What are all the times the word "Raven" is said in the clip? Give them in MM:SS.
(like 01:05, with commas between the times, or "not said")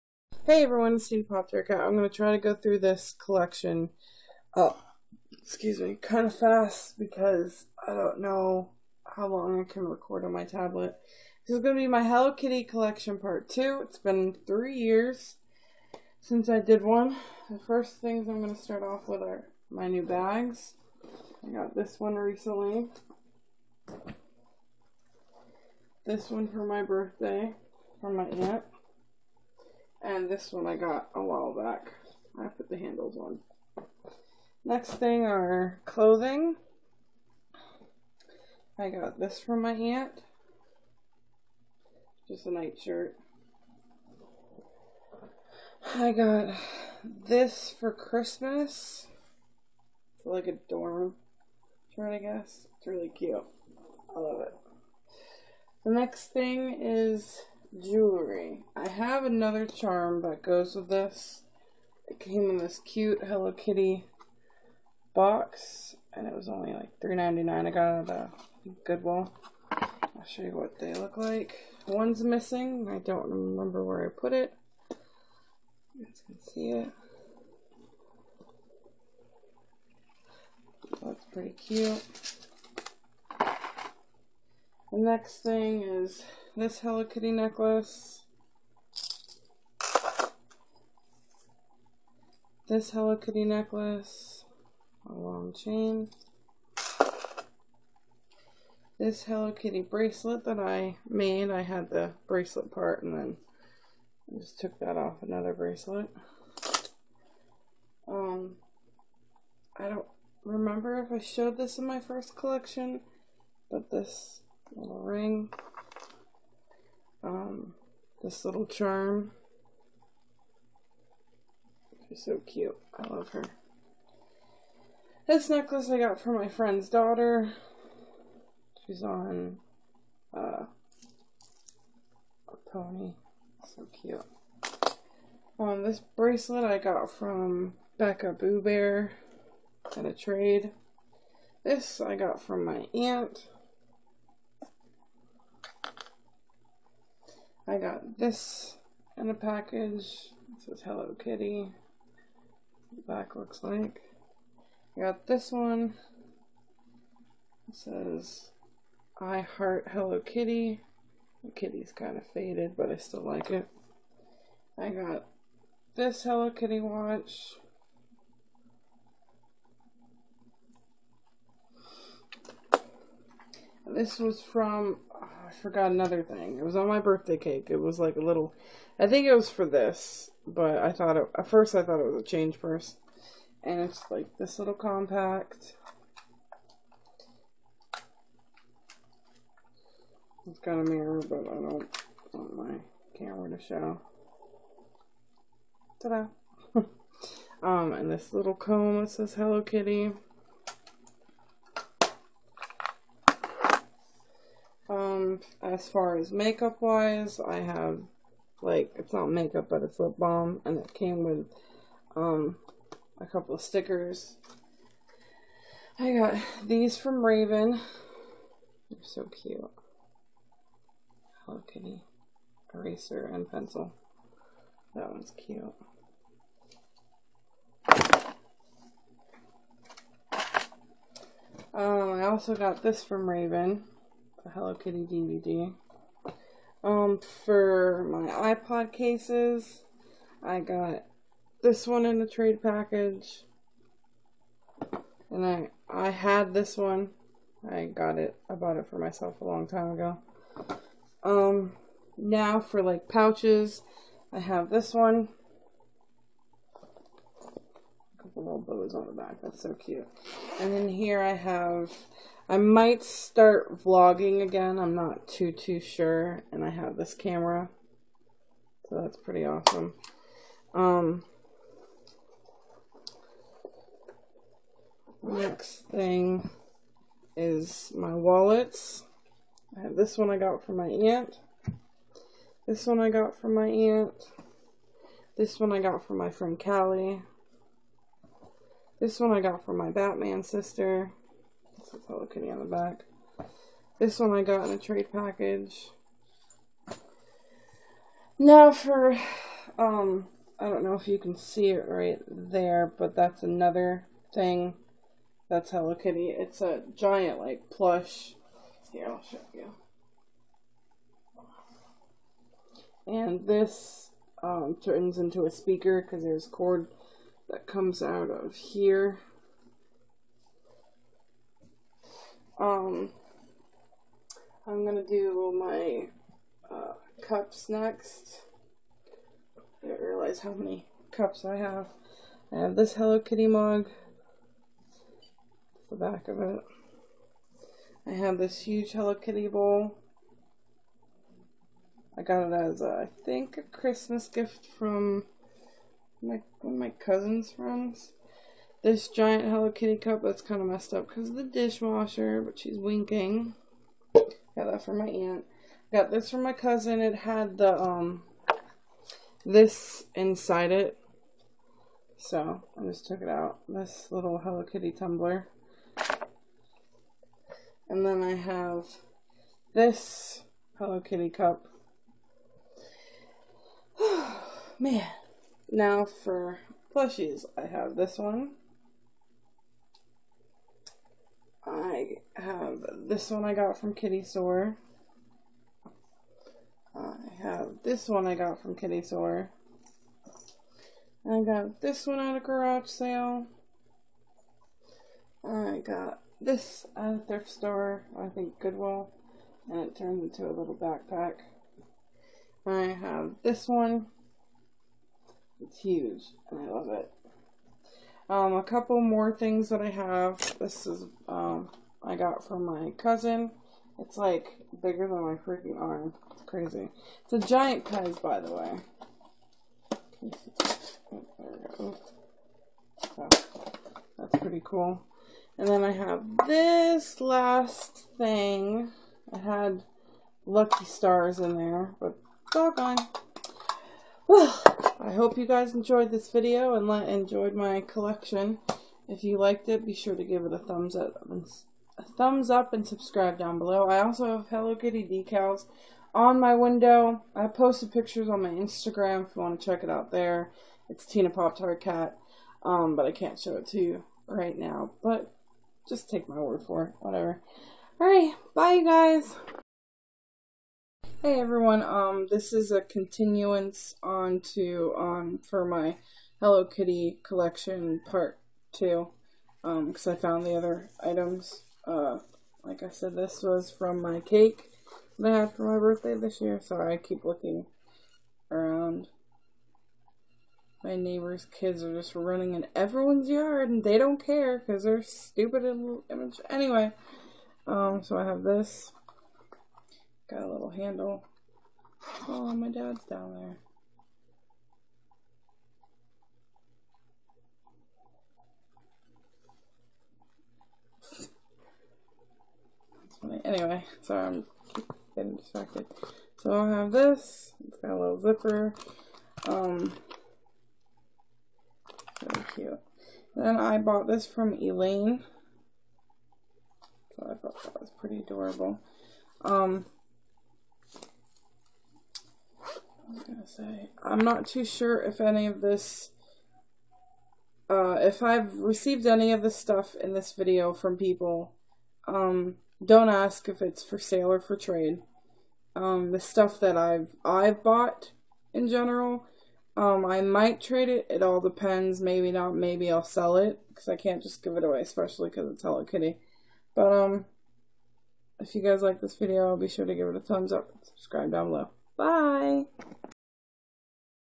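03:37, 03:53.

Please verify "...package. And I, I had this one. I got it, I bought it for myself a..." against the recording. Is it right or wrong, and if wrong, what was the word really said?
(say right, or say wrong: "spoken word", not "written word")
right.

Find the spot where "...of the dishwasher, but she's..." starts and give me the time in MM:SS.
05:51.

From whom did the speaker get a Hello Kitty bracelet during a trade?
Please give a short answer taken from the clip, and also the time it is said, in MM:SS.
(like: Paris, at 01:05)
Becca Boo Bear, at 02:17.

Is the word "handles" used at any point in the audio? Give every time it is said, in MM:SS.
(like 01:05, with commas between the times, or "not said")
00:32, 08:10.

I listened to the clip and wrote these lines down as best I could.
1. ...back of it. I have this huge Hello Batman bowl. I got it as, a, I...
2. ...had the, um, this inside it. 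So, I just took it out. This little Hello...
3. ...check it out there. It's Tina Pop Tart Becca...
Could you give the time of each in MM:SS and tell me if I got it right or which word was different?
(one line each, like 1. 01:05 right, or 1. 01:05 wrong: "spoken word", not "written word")
1. 05:35 wrong: "Kitty", not "Batman"
2. 05:57 right
3. 07:29 wrong: "Cat", not "Becca".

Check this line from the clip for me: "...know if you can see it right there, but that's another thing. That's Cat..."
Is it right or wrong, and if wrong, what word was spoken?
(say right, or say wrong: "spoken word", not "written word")
wrong: "Hello", not "Cat".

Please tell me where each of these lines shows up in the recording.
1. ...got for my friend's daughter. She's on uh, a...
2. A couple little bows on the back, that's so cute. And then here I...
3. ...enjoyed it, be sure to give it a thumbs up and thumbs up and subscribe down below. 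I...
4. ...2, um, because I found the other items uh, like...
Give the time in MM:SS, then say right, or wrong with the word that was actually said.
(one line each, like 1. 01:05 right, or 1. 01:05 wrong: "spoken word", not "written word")
1. 02:05 right
2. 04:18 right
3. 07:19 wrong: "liked", not "enjoyed"
4. 07:48 right.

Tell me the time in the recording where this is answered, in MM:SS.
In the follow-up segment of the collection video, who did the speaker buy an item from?
08:34.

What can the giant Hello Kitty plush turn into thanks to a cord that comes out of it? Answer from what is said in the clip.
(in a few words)
A speaker.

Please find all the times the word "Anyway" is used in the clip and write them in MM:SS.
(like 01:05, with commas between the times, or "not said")
08:06, 08:23.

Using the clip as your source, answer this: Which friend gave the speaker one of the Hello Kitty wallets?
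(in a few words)
Callie.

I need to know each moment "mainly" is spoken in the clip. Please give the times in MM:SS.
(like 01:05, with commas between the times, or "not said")
not said.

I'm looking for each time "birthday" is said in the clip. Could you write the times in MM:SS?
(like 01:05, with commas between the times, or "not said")
00:26, 02:56, 07:55.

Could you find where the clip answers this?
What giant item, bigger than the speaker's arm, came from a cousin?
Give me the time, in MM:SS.
06:57.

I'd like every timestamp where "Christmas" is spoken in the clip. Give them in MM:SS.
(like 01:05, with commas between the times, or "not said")
00:47, 05:43.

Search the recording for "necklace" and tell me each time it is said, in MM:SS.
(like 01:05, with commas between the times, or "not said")
01:27, 01:33, 02:05.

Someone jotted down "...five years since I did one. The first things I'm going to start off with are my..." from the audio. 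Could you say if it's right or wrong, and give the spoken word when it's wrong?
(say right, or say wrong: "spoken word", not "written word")
wrong: "three", not "five".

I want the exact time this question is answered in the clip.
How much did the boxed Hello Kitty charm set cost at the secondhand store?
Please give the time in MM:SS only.
01:06.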